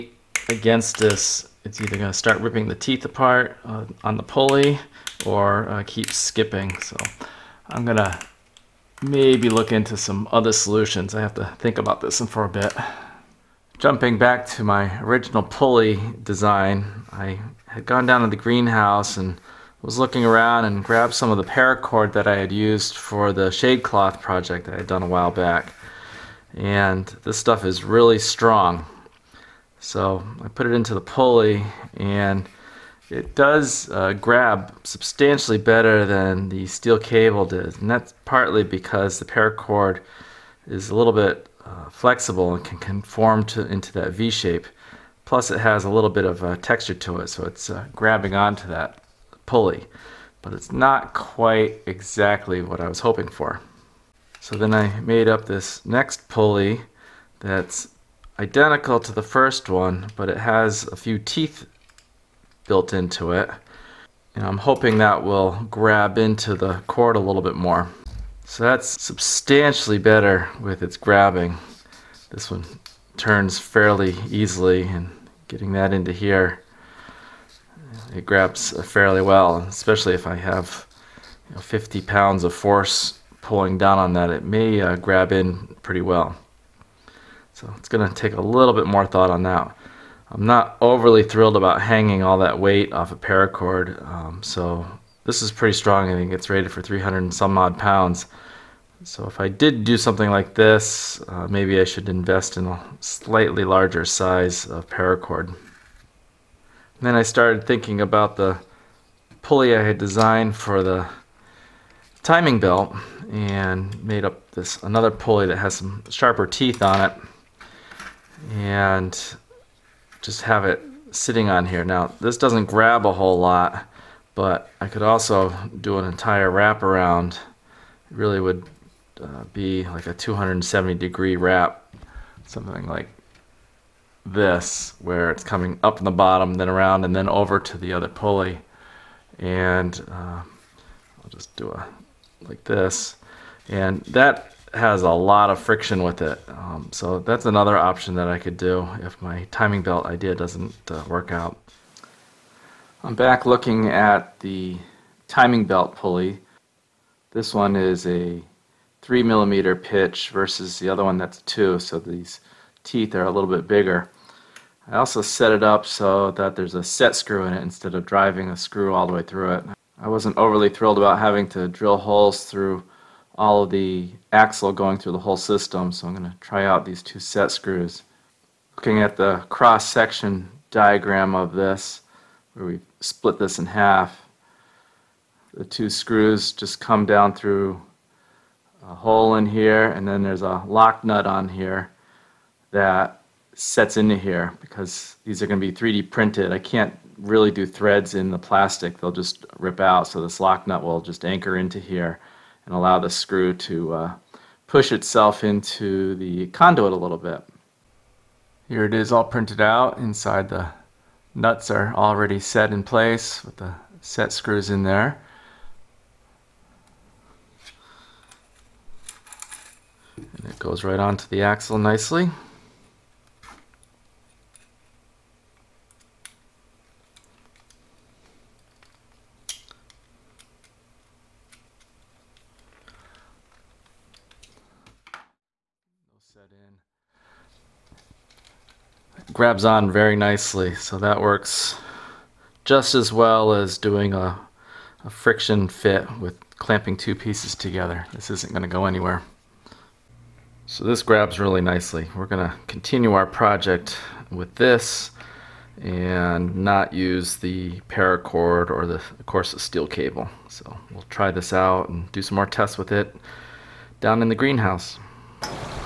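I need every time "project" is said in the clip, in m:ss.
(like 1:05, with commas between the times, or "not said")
0:24, 4:13.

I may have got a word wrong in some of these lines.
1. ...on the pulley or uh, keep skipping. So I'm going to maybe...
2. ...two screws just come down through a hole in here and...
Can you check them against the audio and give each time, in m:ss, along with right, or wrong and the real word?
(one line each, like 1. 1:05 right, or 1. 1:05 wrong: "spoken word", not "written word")
1. 0:04 right
2. 3:05 right.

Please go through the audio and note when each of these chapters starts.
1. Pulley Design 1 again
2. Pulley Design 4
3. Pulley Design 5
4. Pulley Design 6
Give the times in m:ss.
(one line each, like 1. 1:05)
1. 0:13
2. 0:57
3. 1:44
4. 2:31.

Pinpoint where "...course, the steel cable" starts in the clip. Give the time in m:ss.
4:19.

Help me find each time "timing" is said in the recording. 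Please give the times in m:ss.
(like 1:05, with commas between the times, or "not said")
1:52, 2:29, 2:35.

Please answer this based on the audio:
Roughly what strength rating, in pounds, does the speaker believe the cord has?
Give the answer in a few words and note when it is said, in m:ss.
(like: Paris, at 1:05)
300 and some odd pounds, at 1:36.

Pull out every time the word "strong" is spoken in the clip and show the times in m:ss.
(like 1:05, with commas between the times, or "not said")
0:28, 1:35.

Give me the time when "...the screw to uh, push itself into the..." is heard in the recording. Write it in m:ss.
3:22.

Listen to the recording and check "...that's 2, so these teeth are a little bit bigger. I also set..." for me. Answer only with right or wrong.
right.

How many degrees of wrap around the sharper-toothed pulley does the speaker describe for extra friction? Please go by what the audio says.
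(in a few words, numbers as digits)
270 degrees.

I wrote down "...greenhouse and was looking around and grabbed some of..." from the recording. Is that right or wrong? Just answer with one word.
right.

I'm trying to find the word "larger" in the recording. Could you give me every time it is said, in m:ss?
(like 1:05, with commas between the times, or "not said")
1:43.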